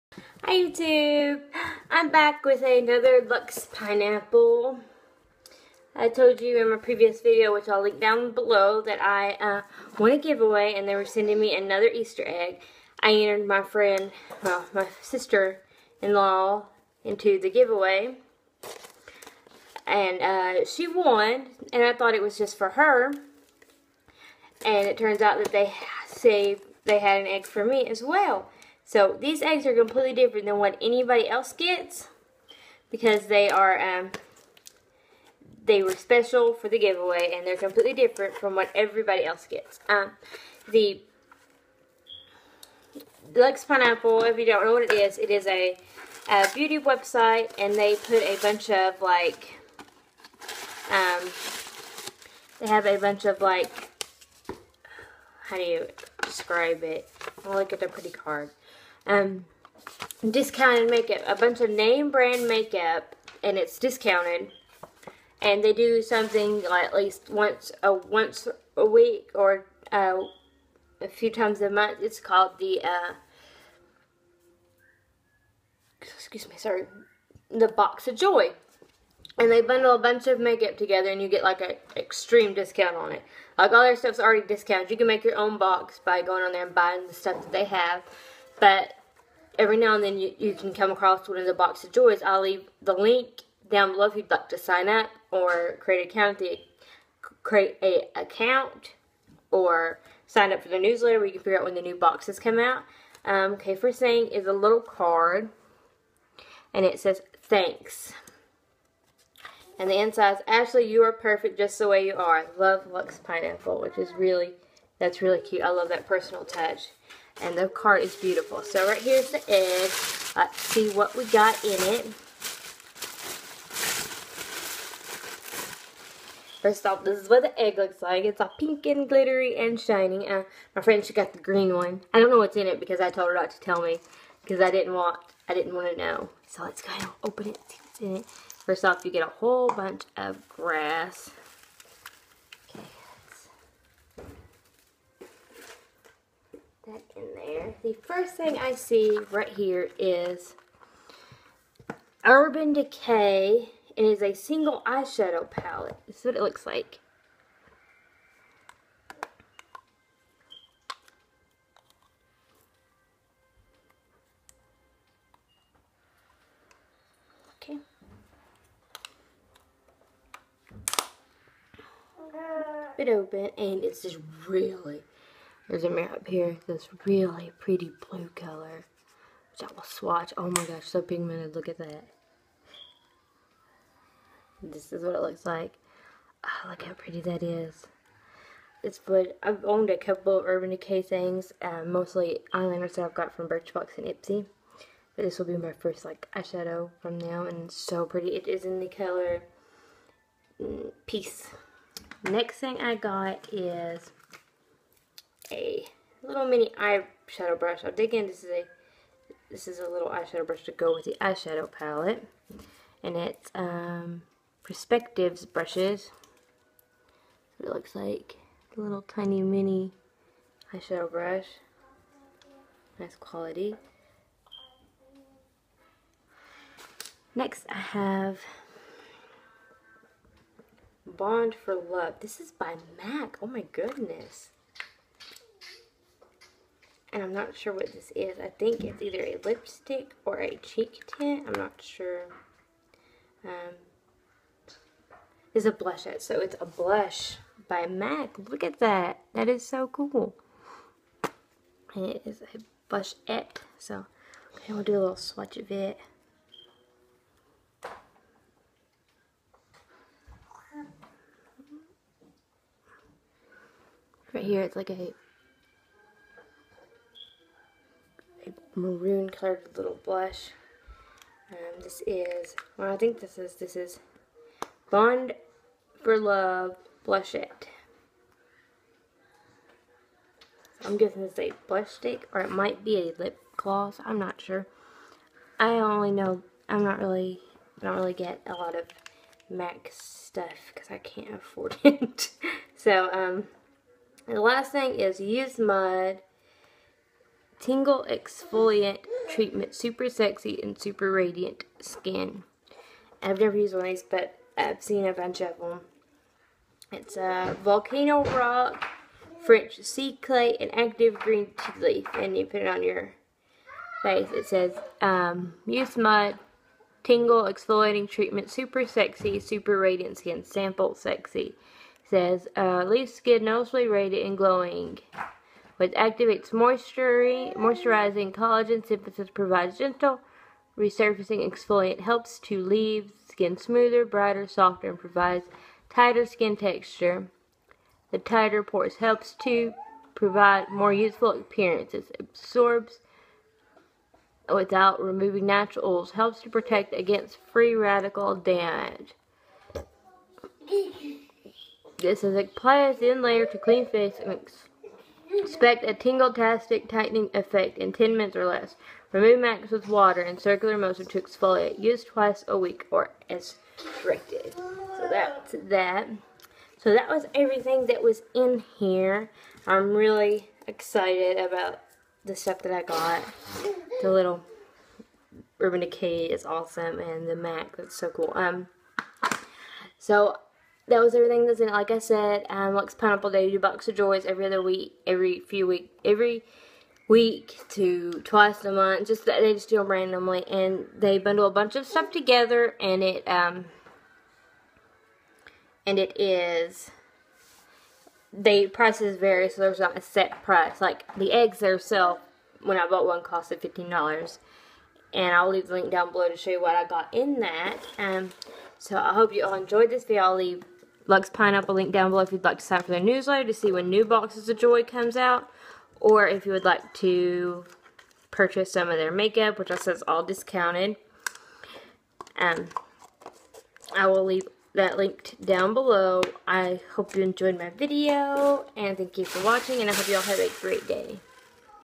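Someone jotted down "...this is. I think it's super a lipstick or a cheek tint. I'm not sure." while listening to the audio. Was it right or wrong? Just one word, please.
wrong.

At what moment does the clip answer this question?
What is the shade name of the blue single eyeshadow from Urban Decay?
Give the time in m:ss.
3:21.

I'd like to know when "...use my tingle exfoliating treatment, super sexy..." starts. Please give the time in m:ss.
5:15.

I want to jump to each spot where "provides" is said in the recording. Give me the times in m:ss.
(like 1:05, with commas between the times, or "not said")
5:29, 5:34, 5:40.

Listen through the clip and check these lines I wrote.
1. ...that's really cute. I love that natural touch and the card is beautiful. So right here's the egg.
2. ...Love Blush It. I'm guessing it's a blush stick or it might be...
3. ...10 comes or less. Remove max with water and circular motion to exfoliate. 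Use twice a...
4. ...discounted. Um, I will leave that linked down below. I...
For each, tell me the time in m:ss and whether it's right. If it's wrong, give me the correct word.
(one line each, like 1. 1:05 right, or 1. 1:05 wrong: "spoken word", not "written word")
1. 1:54 wrong: "personal", not "natural"
2. 4:36 right
3. 5:57 wrong: "minutes", not "comes"
4. 7:00 right.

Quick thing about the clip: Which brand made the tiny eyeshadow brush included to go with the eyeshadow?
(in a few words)
Perspectives.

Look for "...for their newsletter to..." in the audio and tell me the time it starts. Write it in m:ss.
6:52.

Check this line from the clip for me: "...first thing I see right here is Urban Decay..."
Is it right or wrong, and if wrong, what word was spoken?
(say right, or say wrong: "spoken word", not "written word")
right.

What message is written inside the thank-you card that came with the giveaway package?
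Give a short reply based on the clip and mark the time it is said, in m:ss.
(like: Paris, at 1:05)
You are perfect just the way you are, at 1:50.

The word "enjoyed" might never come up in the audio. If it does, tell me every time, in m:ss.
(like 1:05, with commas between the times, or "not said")
6:49, 7:07.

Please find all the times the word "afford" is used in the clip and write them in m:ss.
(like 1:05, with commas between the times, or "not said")
4:51.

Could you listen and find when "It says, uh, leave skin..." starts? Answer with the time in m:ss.
5:22.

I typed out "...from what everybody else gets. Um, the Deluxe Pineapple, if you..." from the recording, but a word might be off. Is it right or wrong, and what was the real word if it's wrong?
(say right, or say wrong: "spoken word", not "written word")
right.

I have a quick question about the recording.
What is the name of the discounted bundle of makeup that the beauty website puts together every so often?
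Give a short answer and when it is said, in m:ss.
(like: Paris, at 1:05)
Box of Joy, at 1:17.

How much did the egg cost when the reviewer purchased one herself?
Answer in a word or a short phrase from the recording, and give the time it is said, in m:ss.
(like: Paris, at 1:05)
$15, at 6:43.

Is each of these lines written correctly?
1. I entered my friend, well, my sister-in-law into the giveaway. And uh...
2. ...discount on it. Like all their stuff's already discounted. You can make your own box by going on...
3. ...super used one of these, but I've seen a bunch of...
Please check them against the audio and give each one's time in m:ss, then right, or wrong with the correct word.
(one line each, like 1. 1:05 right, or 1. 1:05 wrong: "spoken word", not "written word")
1. 0:13 right
2. 1:22 right
3. 5:03 wrong: "never", not "super".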